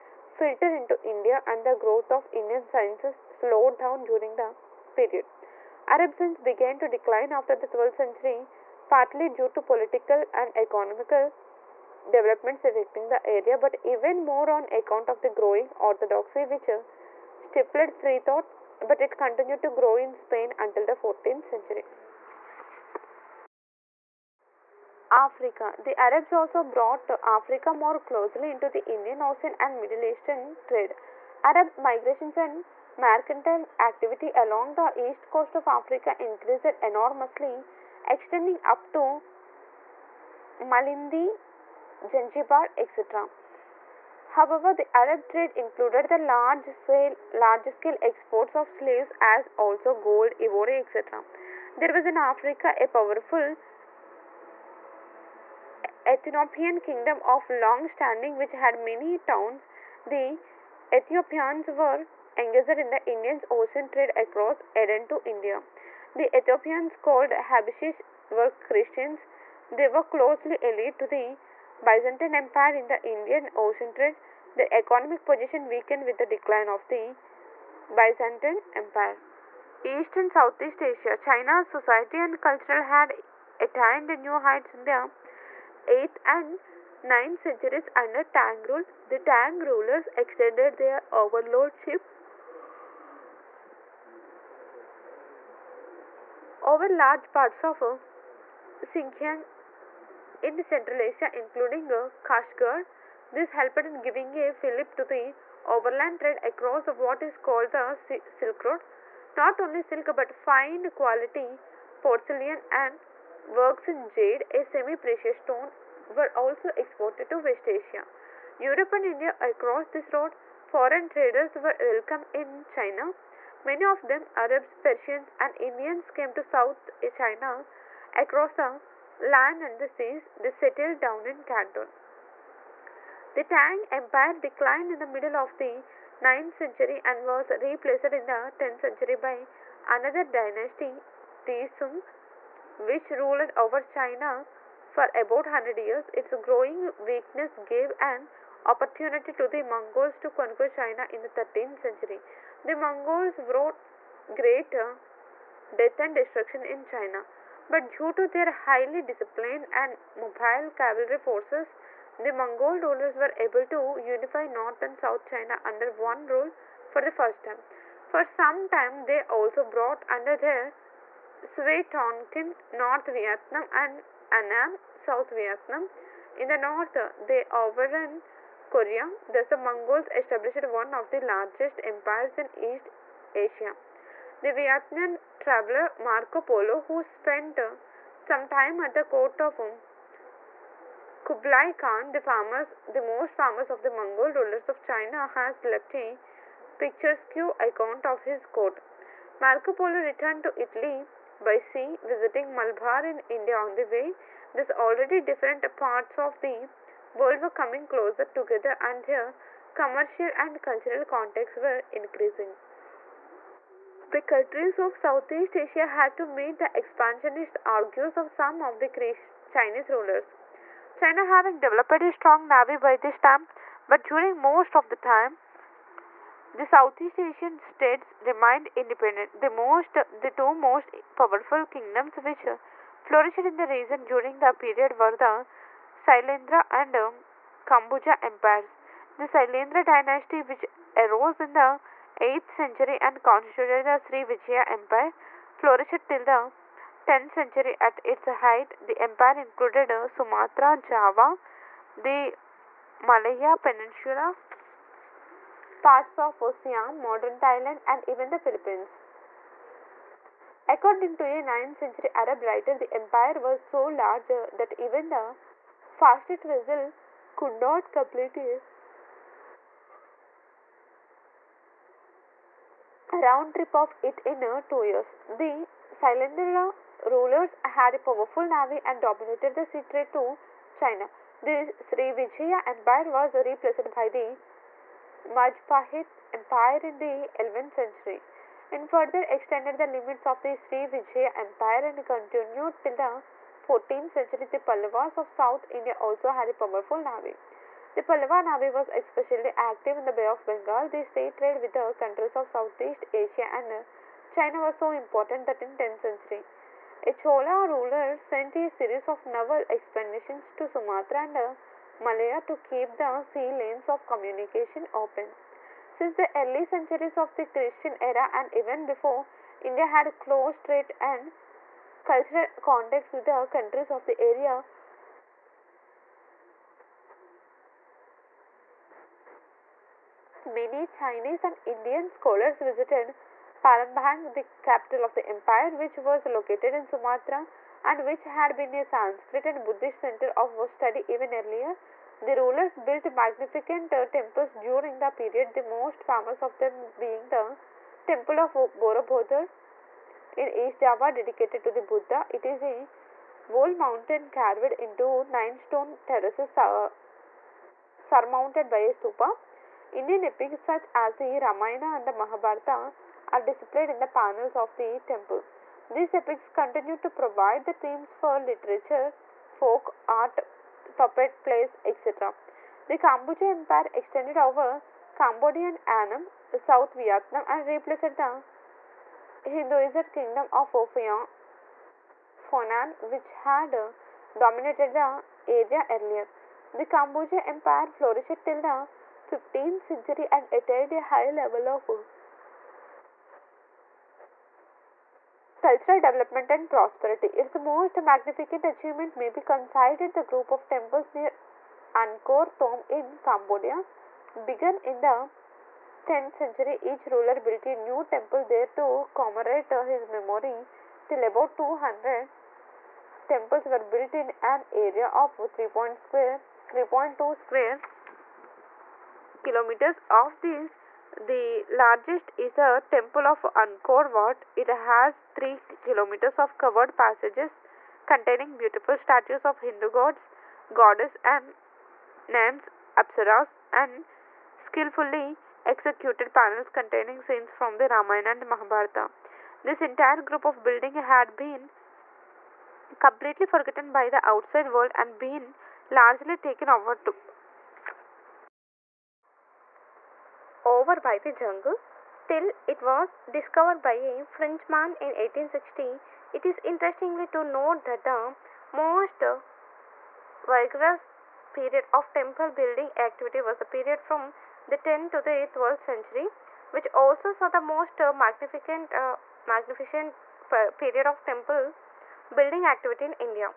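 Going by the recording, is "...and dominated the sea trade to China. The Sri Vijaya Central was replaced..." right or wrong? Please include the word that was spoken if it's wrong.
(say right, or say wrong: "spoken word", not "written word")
wrong: "Empire", not "Central".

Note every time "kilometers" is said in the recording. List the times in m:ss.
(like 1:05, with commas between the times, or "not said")
6:59, 7:05.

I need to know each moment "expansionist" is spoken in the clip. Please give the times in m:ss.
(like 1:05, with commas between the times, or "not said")
3:36.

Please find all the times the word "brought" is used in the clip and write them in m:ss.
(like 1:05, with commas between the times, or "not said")
0:26, 2:49.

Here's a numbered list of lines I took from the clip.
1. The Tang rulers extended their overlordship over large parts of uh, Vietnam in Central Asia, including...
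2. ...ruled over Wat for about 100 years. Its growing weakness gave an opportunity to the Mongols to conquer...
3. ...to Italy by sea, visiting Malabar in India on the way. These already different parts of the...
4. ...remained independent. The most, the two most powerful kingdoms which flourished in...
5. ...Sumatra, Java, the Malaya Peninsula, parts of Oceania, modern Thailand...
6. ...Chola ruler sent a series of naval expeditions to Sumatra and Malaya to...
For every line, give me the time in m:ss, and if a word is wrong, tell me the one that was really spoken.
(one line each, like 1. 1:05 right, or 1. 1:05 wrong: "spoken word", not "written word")
1. 1:29 wrong: "Xinjiang", not "Vietnam"
2. 2:23 wrong: "China", not "Wat"
3. 3:20 right
4. 3:48 right
5. 4:10 right
6. 5:07 right.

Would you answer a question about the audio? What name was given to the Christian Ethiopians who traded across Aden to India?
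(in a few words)
Habishis.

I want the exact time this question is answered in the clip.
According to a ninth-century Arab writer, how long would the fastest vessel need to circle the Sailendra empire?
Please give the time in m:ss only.
4:34.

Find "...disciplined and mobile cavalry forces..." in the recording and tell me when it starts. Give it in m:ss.
2:39.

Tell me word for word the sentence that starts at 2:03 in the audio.
Many of them, Arabs, Persians, and Indians, came to South China across the land and the seas, they settled down in Canton.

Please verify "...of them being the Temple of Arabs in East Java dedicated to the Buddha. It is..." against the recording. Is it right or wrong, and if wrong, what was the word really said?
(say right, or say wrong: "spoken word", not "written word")
wrong: "Borobudur", not "Arabs".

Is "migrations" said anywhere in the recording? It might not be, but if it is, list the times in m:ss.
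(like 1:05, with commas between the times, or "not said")
0:31.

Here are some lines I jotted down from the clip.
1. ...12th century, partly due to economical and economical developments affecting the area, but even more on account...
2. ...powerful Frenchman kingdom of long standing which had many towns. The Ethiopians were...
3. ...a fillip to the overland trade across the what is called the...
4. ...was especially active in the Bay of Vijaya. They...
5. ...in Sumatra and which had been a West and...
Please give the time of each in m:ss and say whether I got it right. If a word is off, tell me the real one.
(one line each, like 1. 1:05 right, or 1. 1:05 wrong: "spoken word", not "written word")
1. 0:07 wrong: "political", not "economical"
2. 0:52 wrong: "Ethiopian", not "Frenchman"
3. 1:44 right
4. 4:58 wrong: "Bengal", not "Vijaya"
5. 5:36 wrong: "Sanskrit", not "West".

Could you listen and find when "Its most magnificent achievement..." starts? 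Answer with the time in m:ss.
6:37.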